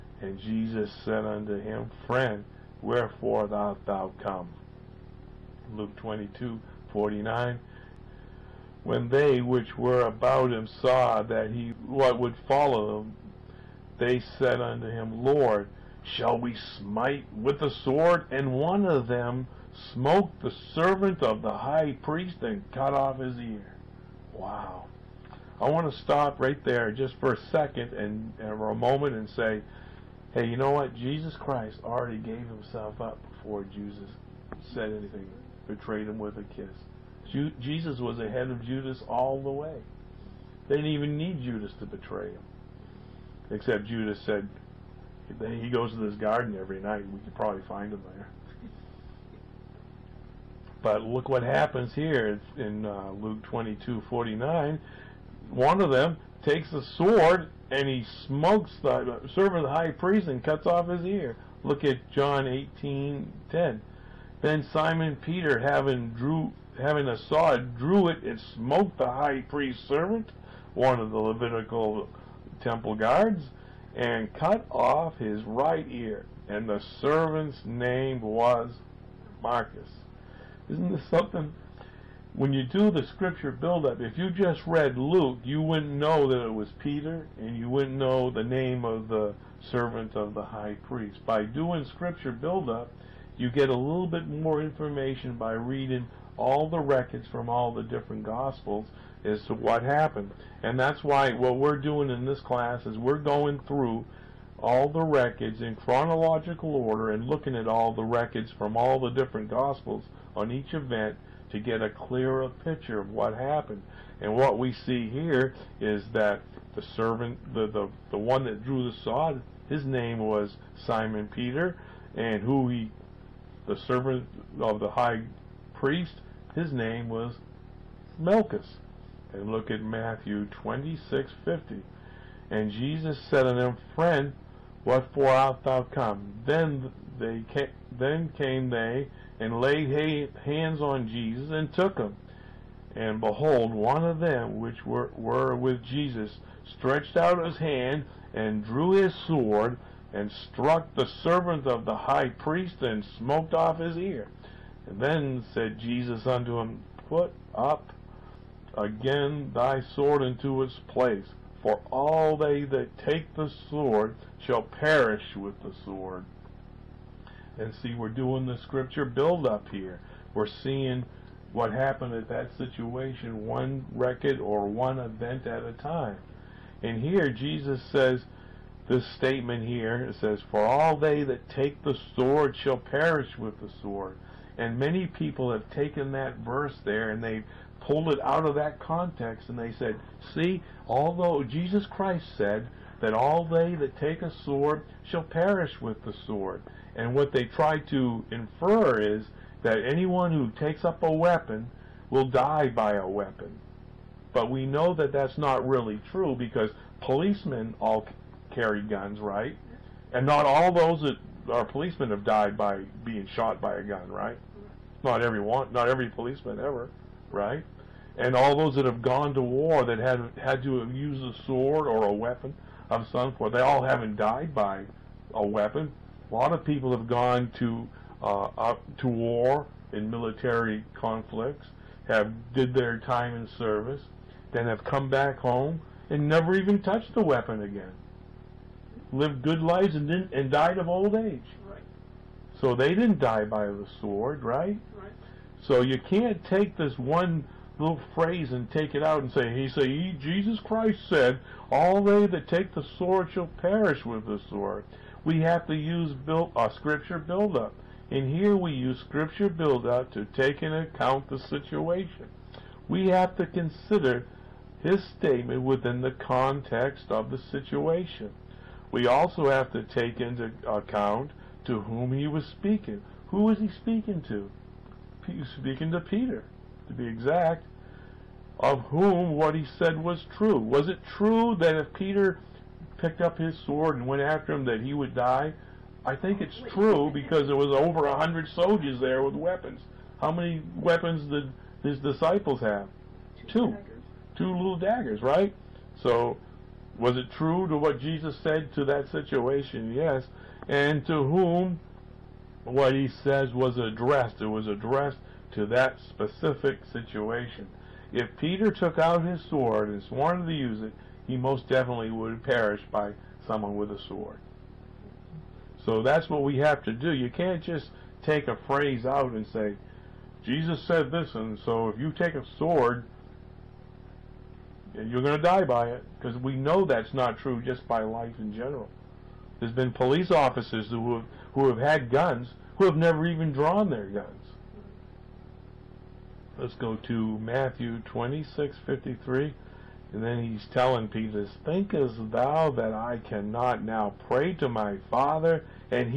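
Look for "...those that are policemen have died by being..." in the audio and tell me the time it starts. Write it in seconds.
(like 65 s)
210 s.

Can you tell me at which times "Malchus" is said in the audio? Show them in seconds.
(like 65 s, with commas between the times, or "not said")
79 s, 128 s.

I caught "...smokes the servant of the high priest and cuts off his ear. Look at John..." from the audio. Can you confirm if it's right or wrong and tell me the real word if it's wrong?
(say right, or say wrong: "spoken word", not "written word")
right.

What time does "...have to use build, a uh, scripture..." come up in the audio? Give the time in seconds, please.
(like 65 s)
255 s.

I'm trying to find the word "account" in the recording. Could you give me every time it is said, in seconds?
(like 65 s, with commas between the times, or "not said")
260 s, 270 s.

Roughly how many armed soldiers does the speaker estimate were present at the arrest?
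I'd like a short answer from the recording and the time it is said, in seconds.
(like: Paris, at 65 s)
over 100, at 287 s.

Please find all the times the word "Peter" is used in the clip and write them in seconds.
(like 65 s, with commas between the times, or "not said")
65 s, 86 s, 121 s, 275 s, 281 s, 308 s, 341 s.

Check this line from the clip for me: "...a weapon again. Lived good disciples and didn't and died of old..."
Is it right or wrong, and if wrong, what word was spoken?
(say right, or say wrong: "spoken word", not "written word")
wrong: "lives", not "disciples".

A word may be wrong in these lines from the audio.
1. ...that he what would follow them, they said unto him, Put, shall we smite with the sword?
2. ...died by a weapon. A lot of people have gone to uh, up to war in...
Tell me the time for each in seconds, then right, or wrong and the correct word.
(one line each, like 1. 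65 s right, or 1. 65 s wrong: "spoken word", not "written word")
1. 11 s wrong: "Lord", not "Put"
2. 224 s right.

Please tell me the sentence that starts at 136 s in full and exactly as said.
Then they came, then came they and laid hands on Jesus and took him.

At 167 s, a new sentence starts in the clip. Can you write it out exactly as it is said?
And see, we're doing the scripture build up here.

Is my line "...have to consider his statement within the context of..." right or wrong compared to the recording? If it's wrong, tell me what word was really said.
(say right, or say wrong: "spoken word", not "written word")
right.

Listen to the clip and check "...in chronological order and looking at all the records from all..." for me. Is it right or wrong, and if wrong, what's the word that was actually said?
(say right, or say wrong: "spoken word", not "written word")
right.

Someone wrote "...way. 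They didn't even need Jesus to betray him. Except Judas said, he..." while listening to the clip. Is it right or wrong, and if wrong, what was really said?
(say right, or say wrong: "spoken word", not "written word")
wrong: "Judas", not "Jesus".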